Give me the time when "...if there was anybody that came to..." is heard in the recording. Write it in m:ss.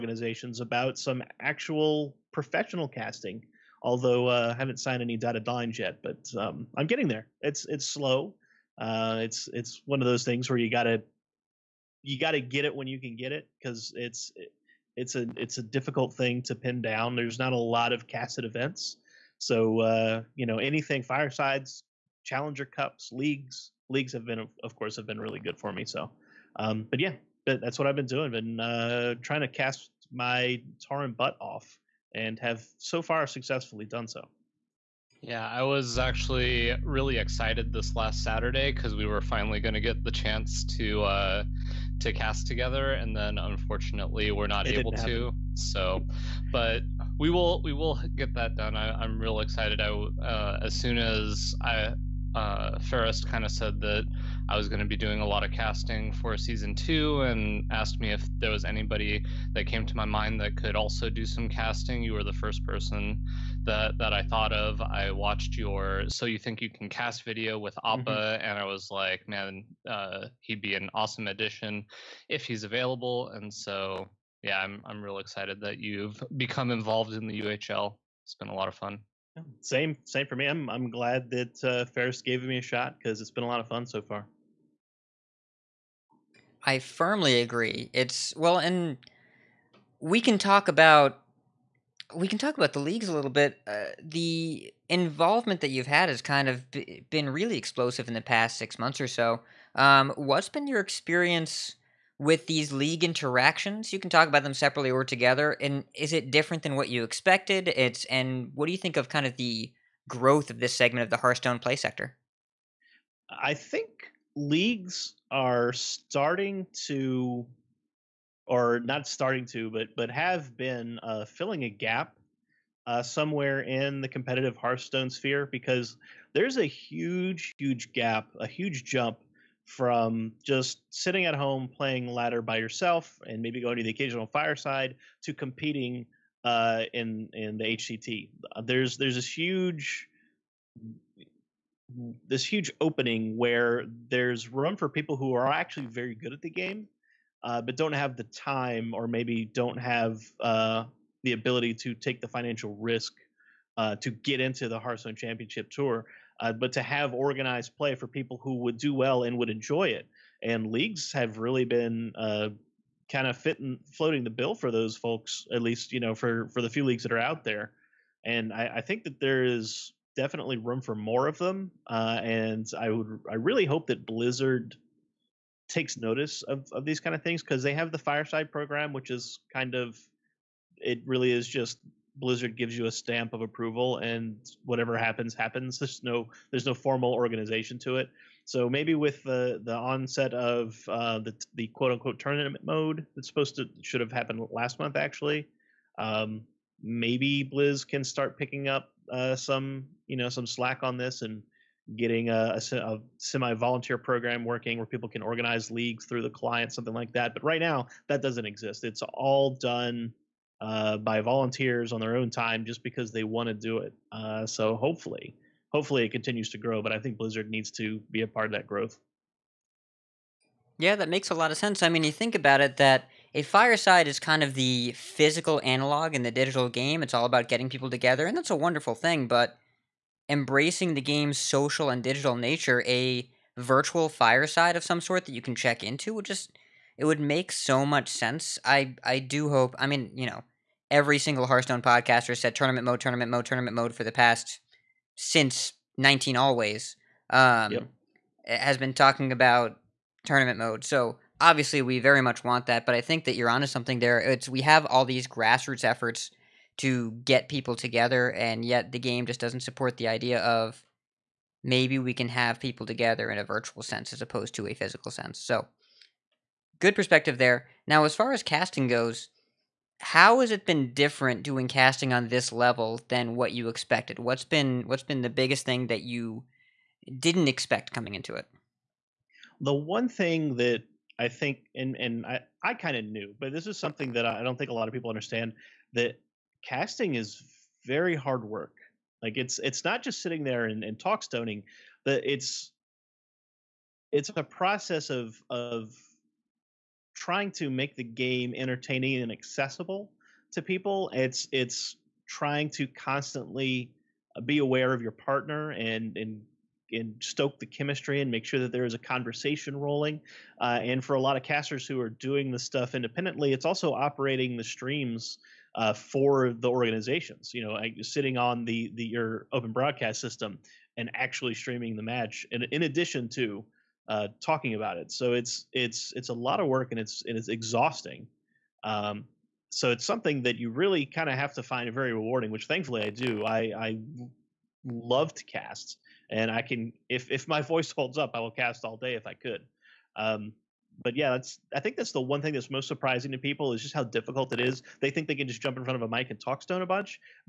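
0:58.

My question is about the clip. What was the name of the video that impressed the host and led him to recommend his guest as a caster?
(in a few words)
So You Think You Can Cast.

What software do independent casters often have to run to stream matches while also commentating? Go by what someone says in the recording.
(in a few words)
open broadcast system.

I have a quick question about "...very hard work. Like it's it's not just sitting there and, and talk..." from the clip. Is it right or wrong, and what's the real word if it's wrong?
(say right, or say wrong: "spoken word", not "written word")
right.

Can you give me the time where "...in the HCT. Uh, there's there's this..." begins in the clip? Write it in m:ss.
2:17.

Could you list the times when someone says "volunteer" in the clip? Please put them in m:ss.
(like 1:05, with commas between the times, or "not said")
3:23, 3:31.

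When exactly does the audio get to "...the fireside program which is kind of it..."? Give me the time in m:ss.
2:57.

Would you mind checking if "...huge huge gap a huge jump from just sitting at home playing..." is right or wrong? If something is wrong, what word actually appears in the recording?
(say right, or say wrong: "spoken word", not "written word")
right.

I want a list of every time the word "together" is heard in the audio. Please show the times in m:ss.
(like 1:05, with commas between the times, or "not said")
0:42, 1:45, 3:47, 4:17, 4:22.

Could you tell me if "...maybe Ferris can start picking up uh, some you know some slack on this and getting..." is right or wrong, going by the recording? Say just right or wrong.
wrong.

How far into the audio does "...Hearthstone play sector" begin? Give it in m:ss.
1:51.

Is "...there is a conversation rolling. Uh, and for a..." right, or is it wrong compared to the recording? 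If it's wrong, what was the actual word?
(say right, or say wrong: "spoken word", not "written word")
right.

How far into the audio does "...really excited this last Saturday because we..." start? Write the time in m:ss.
0:36.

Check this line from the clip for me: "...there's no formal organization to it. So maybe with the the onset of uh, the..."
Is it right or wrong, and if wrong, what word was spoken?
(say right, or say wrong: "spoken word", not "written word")
right.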